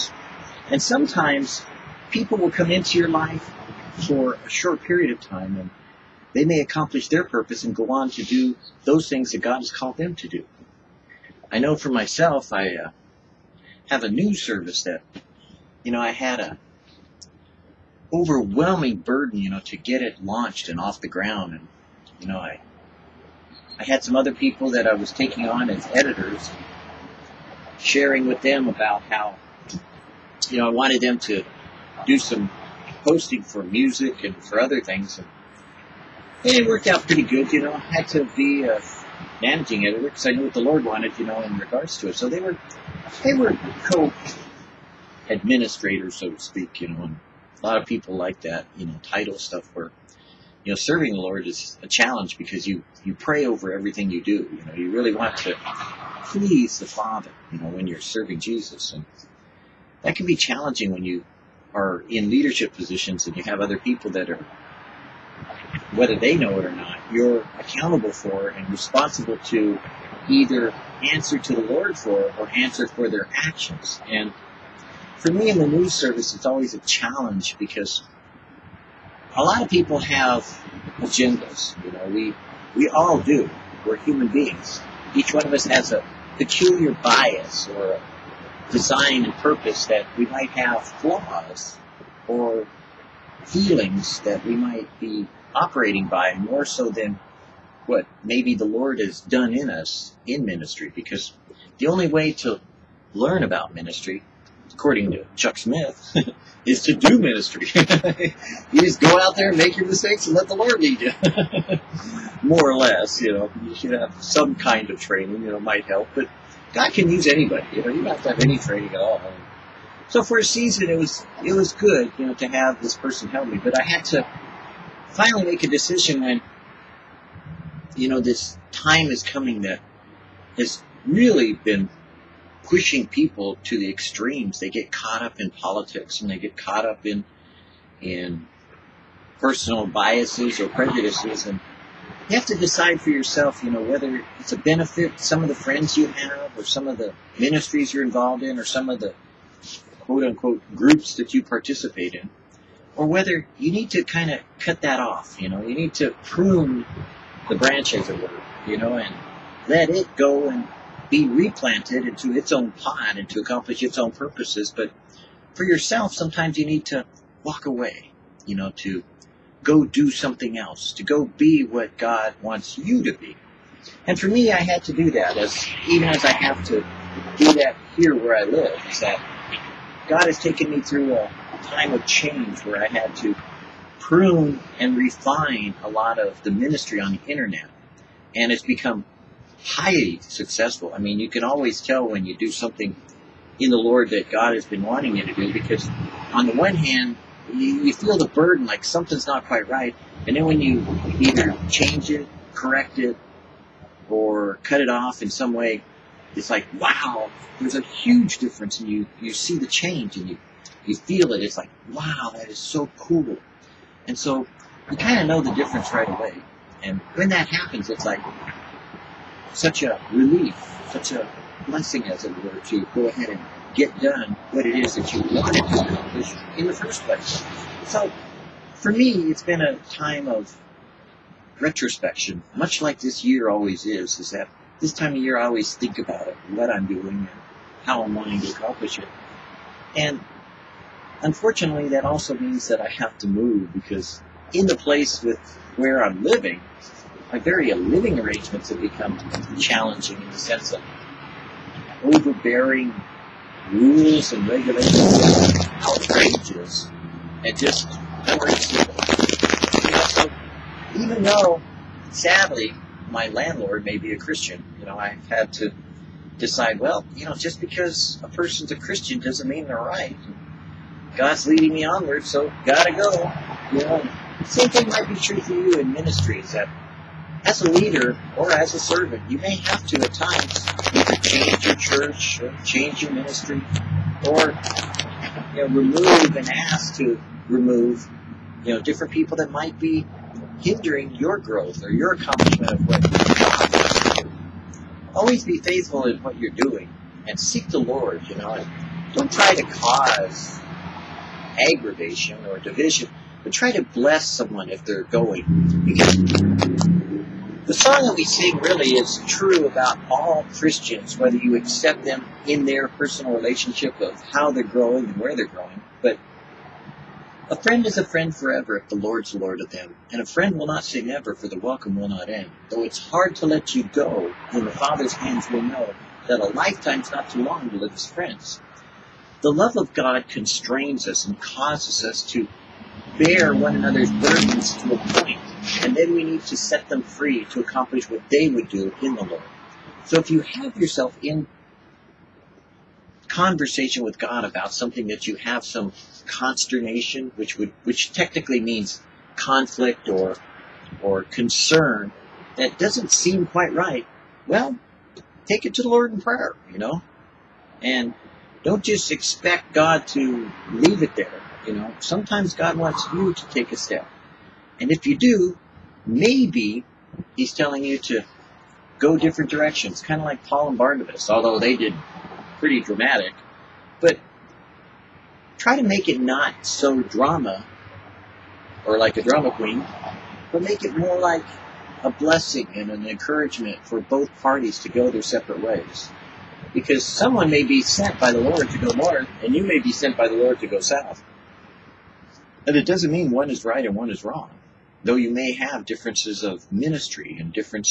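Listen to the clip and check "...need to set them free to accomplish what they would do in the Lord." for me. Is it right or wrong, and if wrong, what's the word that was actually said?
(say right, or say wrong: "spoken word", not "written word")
right.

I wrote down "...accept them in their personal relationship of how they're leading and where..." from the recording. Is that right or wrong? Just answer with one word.
wrong.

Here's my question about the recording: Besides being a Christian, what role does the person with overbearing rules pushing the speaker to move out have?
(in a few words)
landlord.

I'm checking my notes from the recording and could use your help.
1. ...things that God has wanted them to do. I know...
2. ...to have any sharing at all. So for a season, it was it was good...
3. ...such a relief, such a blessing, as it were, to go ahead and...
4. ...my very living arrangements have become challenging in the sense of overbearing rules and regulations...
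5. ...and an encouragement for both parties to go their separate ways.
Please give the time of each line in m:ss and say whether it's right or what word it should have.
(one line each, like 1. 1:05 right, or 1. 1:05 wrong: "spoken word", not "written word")
1. 0:09 wrong: "called", not "wanted"
2. 1:58 wrong: "training", not "sharing"
3. 3:39 right
4. 4:07 right
5. 6:22 right.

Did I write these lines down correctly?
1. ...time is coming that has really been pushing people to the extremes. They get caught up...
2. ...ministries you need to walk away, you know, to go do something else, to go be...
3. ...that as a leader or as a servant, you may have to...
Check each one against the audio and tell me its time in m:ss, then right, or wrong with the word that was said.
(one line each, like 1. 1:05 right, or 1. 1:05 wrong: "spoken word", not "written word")
1. 2:08 right
2. 2:46 wrong: "sometimes", not "ministries"
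3. 4:36 right.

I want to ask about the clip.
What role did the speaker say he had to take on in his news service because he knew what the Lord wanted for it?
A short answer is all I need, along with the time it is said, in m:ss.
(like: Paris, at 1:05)
managing editor, at 0:39.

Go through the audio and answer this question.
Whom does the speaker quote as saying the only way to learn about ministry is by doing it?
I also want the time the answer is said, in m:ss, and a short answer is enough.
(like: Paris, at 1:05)
Chuck Smith, at 1:45.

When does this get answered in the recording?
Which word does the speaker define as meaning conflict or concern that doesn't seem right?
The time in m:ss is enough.
5:46.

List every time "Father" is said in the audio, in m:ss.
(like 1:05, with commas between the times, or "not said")
0:56, 5:24.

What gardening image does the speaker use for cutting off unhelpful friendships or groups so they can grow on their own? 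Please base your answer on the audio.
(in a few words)
prune the branch.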